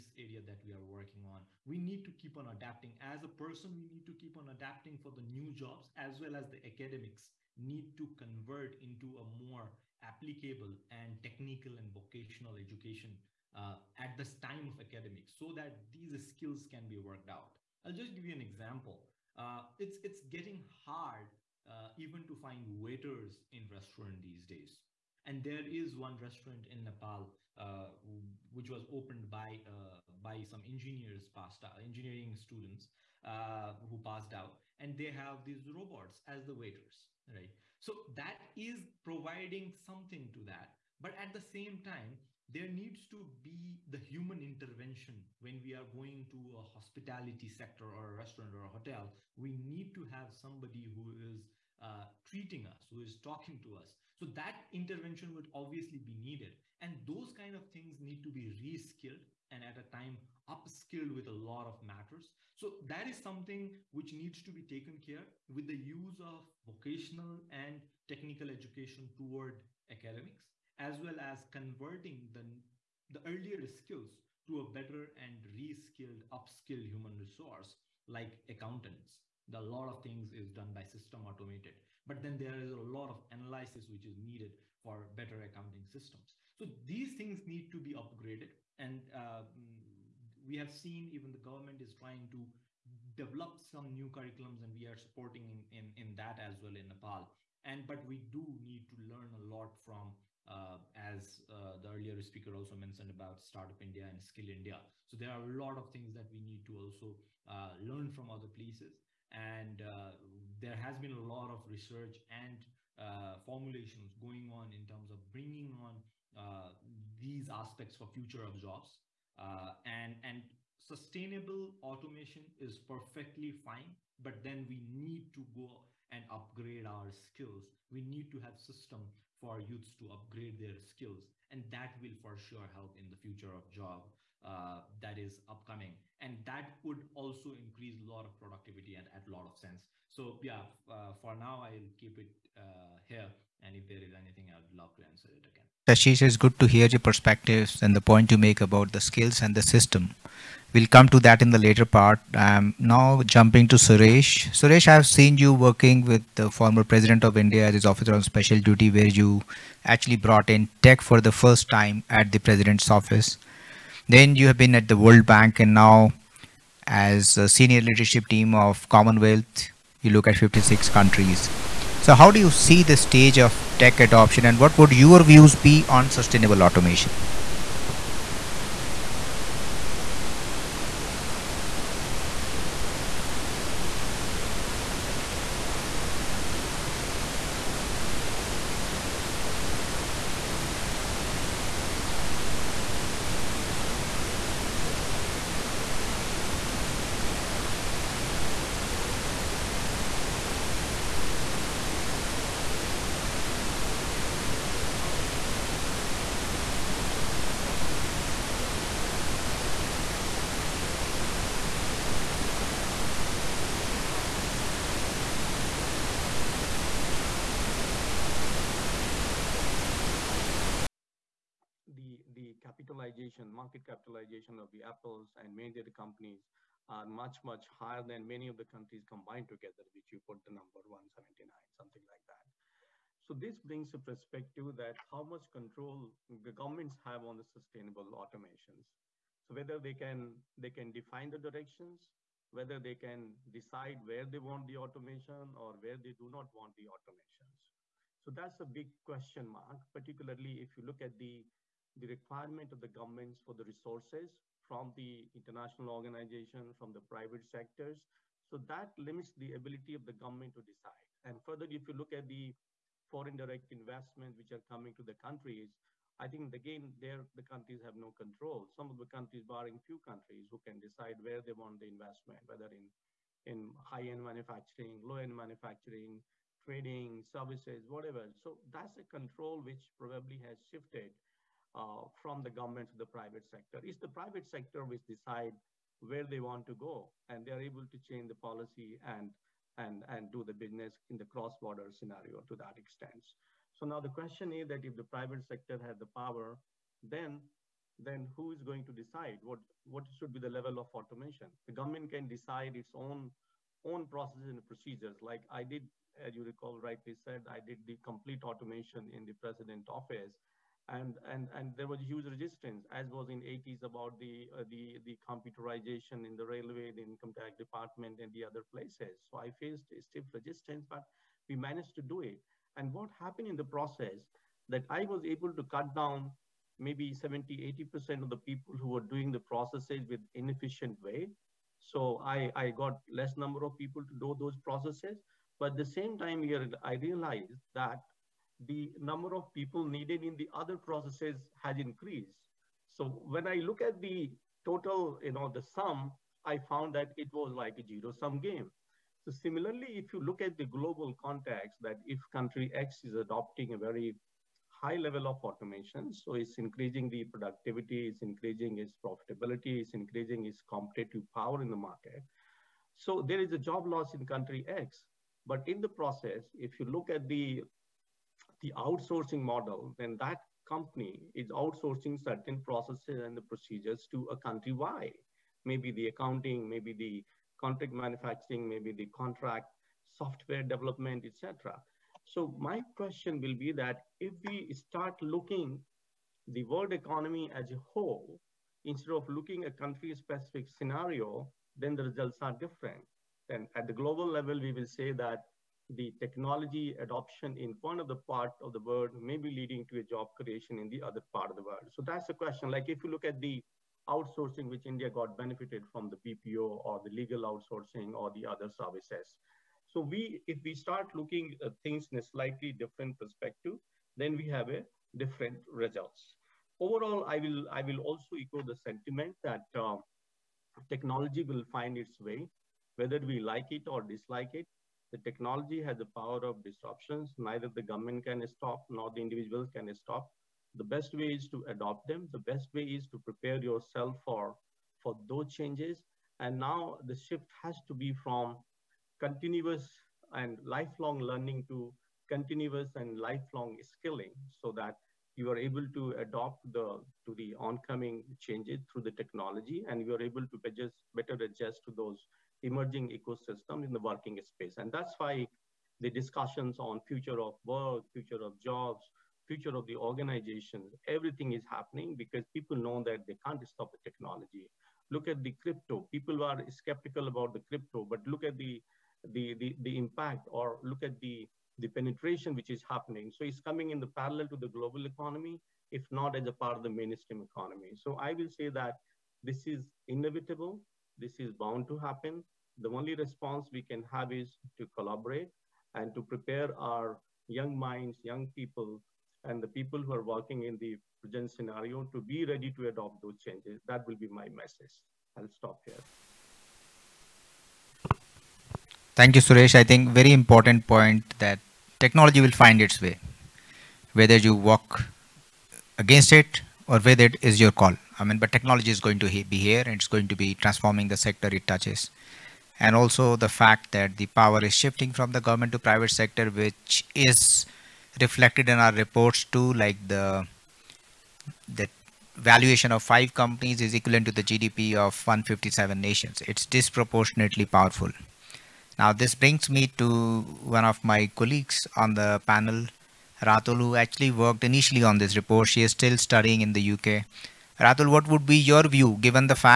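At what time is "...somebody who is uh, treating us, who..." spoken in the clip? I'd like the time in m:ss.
0:50.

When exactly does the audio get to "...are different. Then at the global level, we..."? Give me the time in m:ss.
6:32.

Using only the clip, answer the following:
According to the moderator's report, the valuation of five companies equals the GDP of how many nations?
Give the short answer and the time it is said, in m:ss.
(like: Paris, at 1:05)
157, at 8:45.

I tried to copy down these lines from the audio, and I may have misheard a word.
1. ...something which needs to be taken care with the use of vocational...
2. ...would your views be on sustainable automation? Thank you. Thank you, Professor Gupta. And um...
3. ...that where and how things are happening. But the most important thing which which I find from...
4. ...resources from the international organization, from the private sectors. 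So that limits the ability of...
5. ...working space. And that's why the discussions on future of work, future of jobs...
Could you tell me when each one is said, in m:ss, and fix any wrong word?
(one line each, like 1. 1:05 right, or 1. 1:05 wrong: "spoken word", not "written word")
1. 1:03 right
2. 2:54 right
3. 3:23 right
4. 4:13 right
5. 7:33 right.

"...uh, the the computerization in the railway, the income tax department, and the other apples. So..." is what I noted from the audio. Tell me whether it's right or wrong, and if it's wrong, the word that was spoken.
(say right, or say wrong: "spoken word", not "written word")
wrong: "places", not "apples".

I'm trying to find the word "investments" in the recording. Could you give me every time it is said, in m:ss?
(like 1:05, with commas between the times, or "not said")
4:23, 4:31.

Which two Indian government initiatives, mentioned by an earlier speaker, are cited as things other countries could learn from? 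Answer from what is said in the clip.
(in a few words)
Startup India and Skill India.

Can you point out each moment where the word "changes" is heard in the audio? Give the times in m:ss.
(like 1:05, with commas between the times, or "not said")
4:48, 7:15, 7:28, 8:13.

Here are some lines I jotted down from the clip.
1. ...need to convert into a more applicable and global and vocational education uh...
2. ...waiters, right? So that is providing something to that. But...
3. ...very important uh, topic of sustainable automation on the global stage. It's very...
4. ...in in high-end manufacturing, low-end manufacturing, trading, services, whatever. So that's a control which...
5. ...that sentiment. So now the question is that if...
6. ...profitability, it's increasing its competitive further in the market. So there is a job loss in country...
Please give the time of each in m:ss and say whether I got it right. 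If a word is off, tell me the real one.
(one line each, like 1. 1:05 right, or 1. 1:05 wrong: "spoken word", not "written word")
1. 0:07 wrong: "technical", not "global"
2. 0:36 right
3. 3:07 right
4. 4:32 right
5. 4:52 wrong: "extent", not "sentiment"
6. 5:59 wrong: "power", not "further".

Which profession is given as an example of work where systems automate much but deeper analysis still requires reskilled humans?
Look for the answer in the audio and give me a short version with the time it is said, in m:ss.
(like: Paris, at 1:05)
Accountants, at 1:18.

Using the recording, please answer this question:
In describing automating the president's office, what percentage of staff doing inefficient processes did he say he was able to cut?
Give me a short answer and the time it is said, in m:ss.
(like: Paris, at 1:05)
70 to 80%, at 5:27.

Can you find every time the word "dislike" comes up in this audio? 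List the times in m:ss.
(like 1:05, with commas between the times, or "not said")
7:04.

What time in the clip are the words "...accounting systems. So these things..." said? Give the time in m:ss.
1:25.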